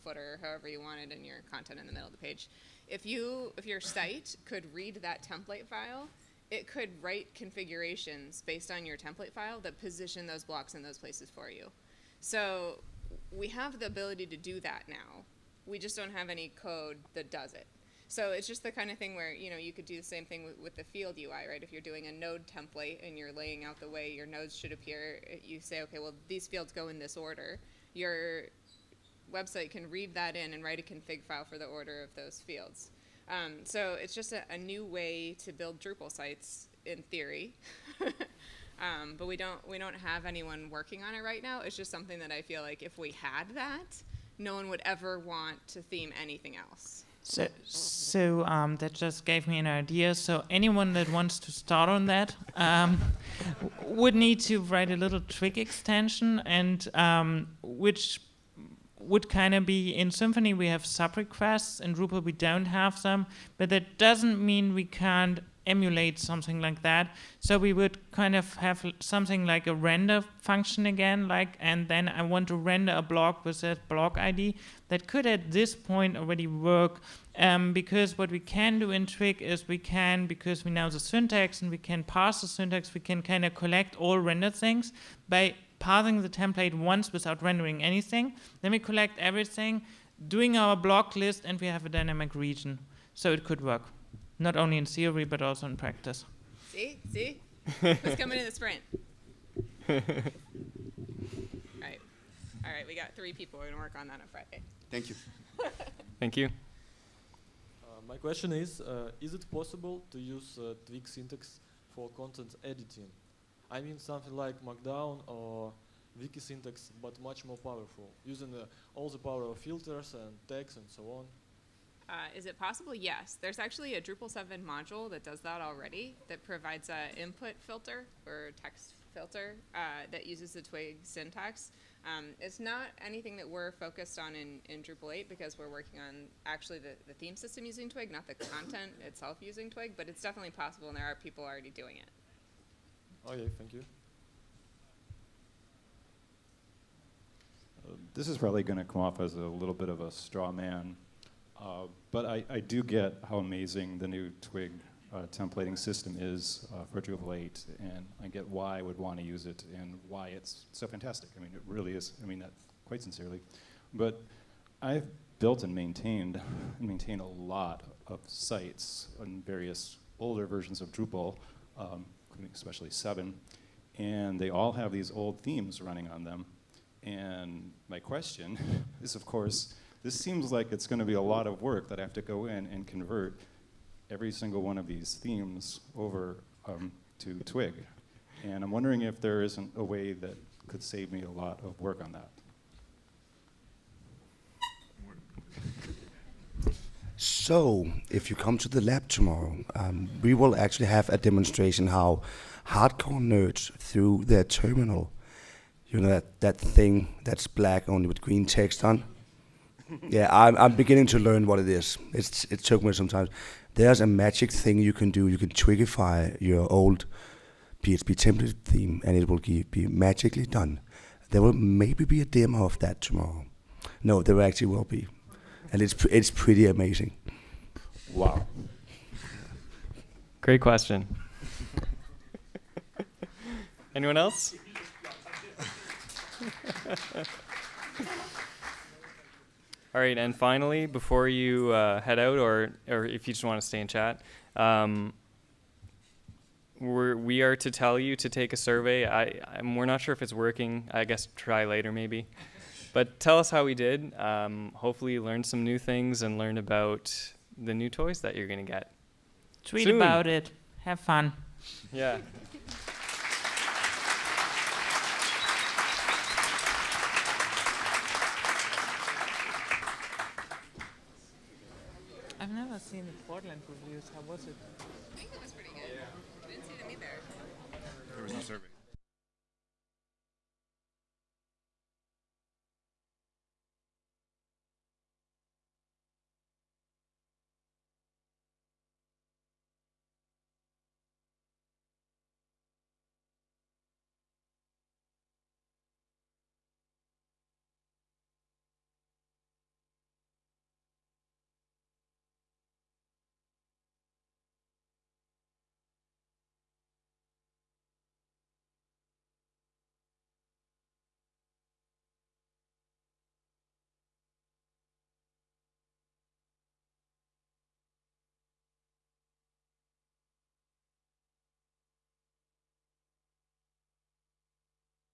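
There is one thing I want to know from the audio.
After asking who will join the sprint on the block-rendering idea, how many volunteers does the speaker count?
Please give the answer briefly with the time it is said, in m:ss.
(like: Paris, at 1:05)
3, at 1:43.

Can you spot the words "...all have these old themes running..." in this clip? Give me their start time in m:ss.
2:54.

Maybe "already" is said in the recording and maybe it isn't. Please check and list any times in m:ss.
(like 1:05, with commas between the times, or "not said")
1:16, 2:05, 2:21.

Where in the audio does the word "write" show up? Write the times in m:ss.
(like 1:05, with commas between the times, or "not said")
0:07, 0:30, 0:54.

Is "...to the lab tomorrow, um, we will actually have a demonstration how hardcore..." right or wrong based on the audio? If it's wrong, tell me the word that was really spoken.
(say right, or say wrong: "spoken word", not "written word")
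right.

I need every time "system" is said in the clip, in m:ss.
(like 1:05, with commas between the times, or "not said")
2:17, 2:35.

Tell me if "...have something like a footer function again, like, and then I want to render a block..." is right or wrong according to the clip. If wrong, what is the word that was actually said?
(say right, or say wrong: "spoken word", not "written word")
wrong: "render", not "footer".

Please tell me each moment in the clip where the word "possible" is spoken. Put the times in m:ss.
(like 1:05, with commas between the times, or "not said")
1:49, 2:02, 2:20.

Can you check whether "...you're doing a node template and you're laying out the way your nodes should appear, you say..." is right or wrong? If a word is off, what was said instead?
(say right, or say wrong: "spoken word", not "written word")
right.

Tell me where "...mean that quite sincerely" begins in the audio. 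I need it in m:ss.
2:42.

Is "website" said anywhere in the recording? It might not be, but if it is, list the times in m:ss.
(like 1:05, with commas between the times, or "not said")
0:29.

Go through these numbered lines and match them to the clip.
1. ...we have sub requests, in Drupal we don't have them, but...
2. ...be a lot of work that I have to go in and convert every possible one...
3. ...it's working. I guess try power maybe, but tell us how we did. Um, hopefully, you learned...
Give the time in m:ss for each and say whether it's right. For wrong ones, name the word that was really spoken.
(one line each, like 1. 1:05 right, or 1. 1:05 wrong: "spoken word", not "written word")
1. 1:00 right
2. 3:01 wrong: "single", not "possible"
3. 4:10 wrong: "later", not "power".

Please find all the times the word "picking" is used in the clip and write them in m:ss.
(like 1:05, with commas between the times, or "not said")
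not said.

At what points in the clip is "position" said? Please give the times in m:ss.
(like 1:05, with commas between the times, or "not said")
0:09.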